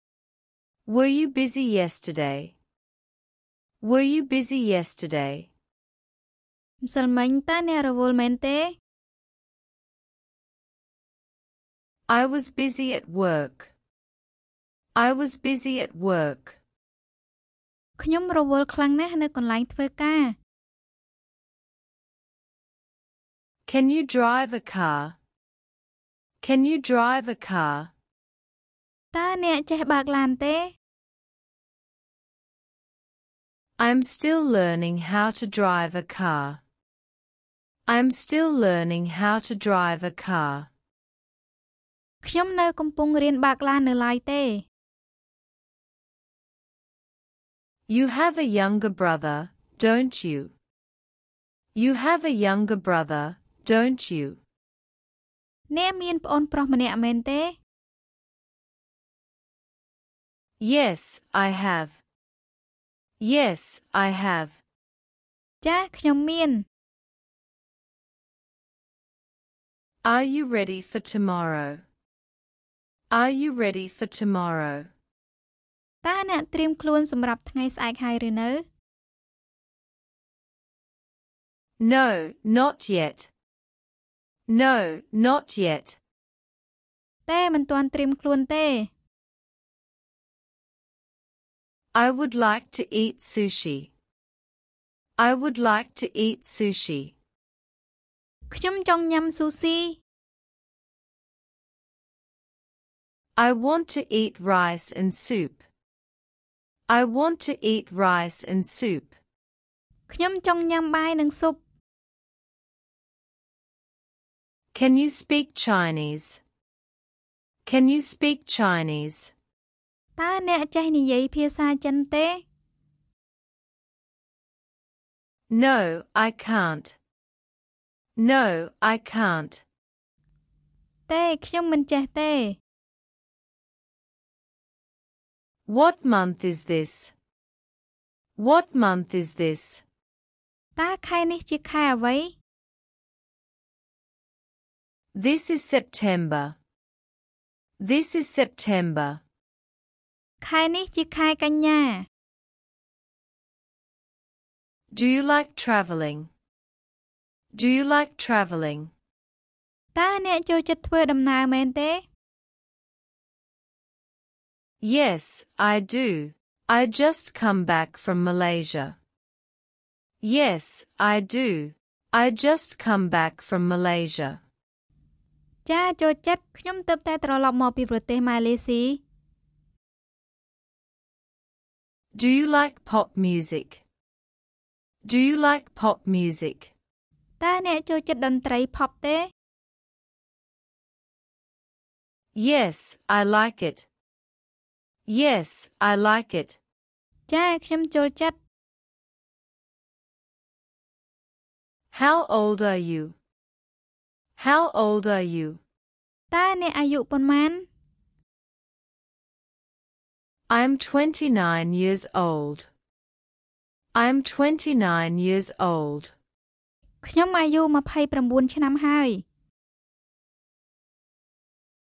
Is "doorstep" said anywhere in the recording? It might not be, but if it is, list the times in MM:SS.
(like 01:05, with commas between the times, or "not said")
not said.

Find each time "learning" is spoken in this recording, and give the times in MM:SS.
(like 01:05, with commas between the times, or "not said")
00:34, 00:38.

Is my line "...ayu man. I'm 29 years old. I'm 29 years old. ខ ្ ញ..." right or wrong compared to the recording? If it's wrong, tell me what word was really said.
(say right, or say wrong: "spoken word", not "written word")
right.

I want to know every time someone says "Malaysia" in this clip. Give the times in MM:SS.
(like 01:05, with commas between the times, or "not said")
02:48, 02:53.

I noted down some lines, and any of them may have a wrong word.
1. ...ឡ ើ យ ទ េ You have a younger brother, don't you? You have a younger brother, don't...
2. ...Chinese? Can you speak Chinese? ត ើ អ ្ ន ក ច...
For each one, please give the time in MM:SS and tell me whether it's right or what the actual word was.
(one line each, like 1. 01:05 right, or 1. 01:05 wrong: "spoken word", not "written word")
1. 00:44 right
2. 01:55 right.